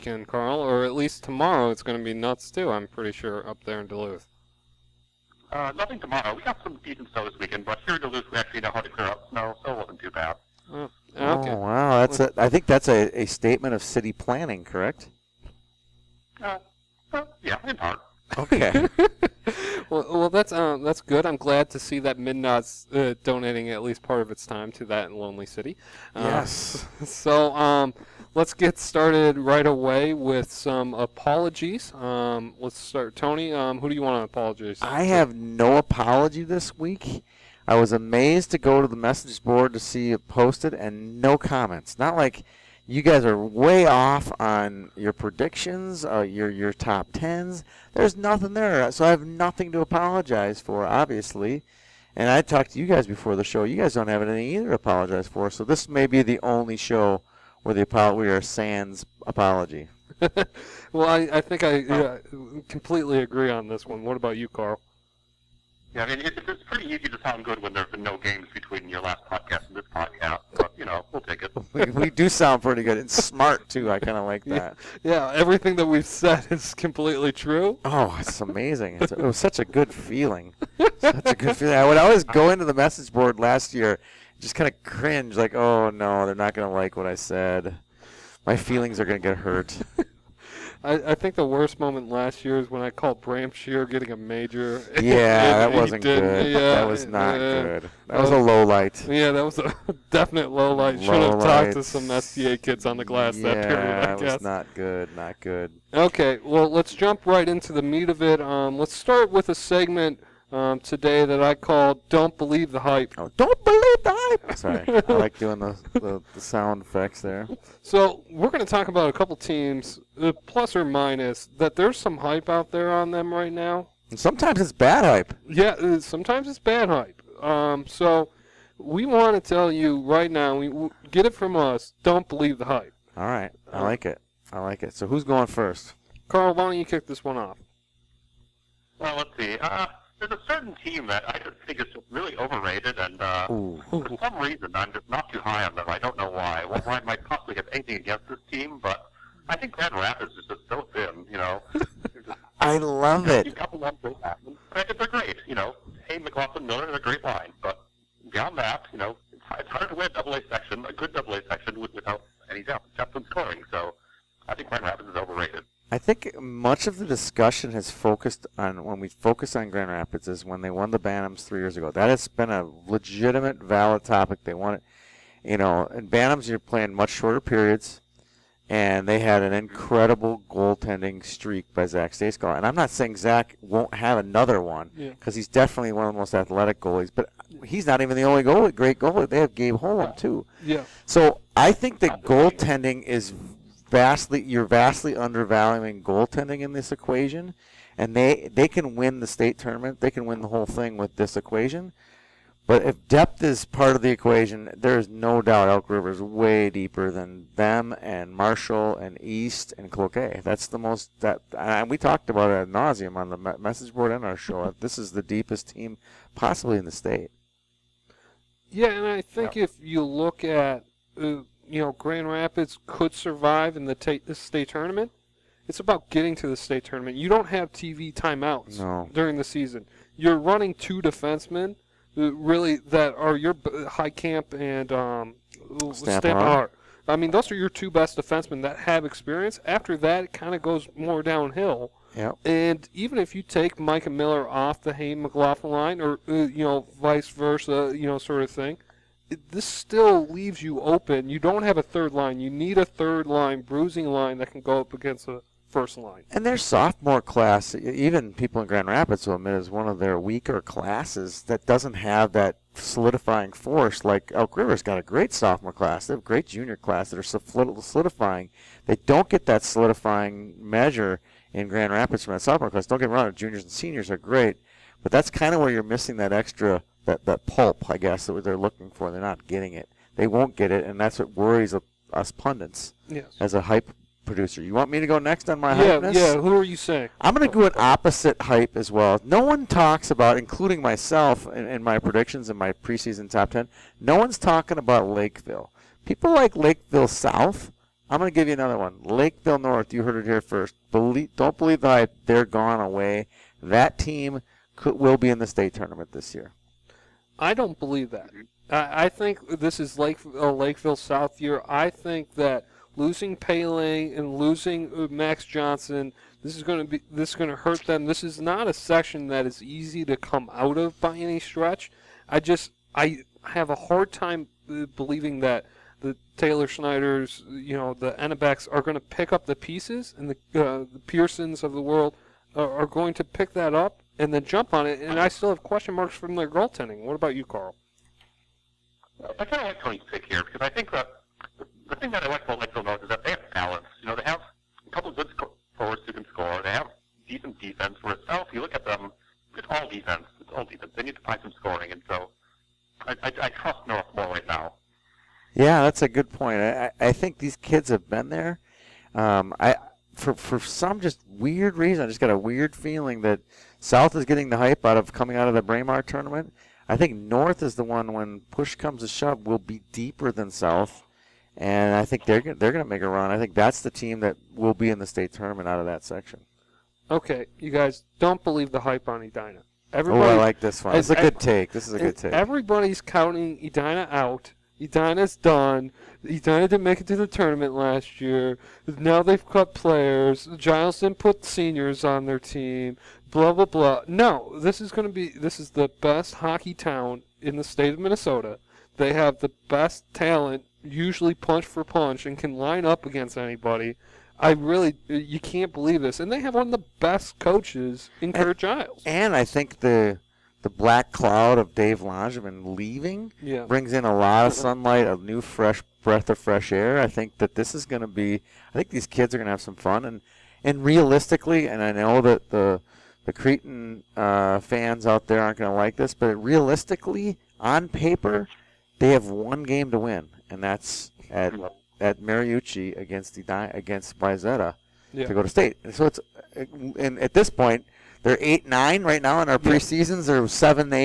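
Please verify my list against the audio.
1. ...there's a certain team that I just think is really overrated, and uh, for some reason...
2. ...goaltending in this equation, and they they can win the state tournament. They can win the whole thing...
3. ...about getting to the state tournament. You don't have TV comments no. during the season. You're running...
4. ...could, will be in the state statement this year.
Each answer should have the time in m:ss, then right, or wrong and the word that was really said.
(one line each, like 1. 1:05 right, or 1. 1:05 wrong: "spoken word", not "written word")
1. 2:20 right
2. 3:16 right
3. 3:45 wrong: "timeouts", not "comments"
4. 5:04 wrong: "tournament", not "statement".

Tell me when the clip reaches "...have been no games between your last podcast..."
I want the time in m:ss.
1:07.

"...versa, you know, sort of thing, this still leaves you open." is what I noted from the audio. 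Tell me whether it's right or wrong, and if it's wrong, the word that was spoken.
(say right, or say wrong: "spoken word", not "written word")
right.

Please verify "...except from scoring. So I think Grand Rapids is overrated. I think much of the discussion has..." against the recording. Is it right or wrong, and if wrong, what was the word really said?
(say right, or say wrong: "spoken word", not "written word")
right.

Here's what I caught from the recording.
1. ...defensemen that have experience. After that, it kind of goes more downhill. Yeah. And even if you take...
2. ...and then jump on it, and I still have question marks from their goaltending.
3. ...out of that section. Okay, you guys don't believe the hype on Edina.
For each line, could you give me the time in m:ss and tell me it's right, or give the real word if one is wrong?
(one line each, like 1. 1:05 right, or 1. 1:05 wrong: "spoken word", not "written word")
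1. 3:58 right
2. 5:34 right
3. 6:15 right.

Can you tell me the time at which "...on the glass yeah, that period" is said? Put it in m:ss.
1:42.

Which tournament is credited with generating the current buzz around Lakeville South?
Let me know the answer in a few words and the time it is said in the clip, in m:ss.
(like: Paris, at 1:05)
Braemar tournament, at 6:05.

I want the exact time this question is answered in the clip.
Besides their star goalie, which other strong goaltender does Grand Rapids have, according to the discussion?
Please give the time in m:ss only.
3:09.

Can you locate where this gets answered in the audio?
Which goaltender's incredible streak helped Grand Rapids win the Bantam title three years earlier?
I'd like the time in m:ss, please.
3:01.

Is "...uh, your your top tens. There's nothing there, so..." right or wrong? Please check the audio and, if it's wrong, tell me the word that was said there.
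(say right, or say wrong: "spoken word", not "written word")
right.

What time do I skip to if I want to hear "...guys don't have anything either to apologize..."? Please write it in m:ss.
0:53.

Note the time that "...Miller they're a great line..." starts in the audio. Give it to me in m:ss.
2:36.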